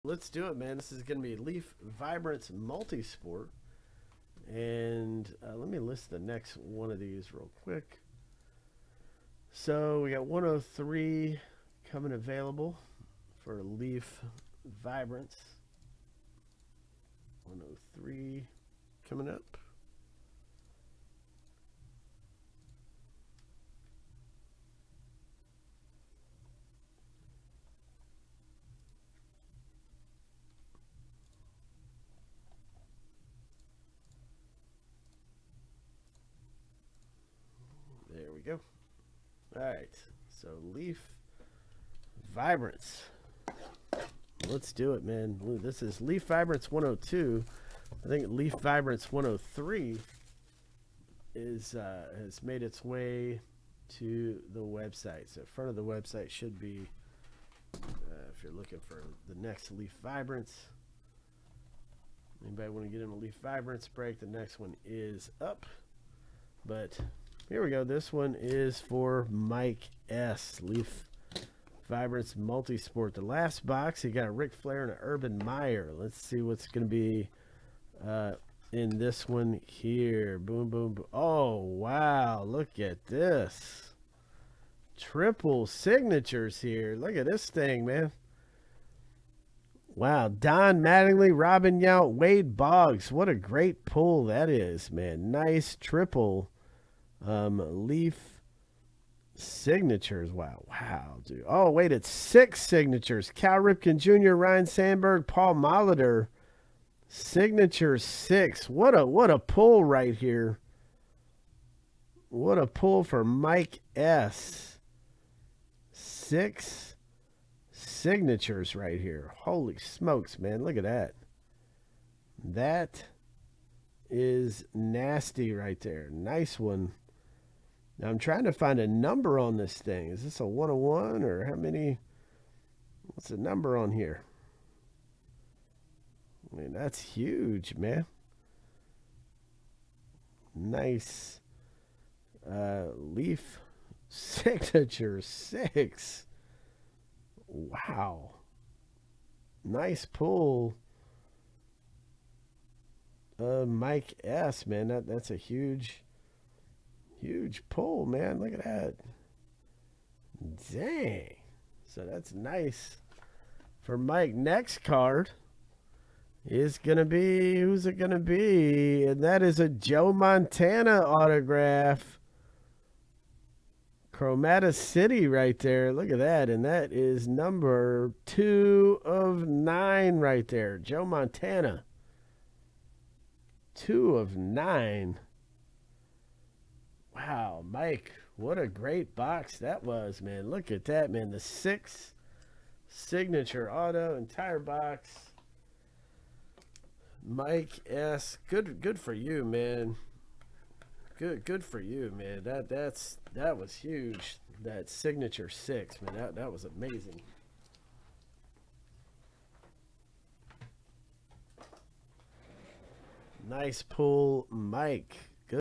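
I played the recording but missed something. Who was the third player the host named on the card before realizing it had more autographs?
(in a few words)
Wade Boggs.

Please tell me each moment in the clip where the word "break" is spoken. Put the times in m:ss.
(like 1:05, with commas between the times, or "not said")
1:03.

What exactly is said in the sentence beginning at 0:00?
This is going to be Leaf Vibrance Multisport.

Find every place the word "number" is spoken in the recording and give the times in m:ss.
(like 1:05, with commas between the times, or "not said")
2:08, 2:13, 2:57.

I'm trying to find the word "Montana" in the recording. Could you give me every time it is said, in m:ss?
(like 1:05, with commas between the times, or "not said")
2:50, 3:01.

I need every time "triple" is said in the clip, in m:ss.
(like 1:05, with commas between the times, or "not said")
1:24, 1:35.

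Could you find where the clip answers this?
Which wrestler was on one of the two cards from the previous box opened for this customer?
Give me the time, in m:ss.
1:14.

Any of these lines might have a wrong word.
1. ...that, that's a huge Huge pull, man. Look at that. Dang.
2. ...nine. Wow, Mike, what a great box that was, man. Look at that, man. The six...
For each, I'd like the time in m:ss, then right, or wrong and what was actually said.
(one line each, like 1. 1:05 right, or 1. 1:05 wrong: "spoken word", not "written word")
1. 2:34 right
2. 3:04 right.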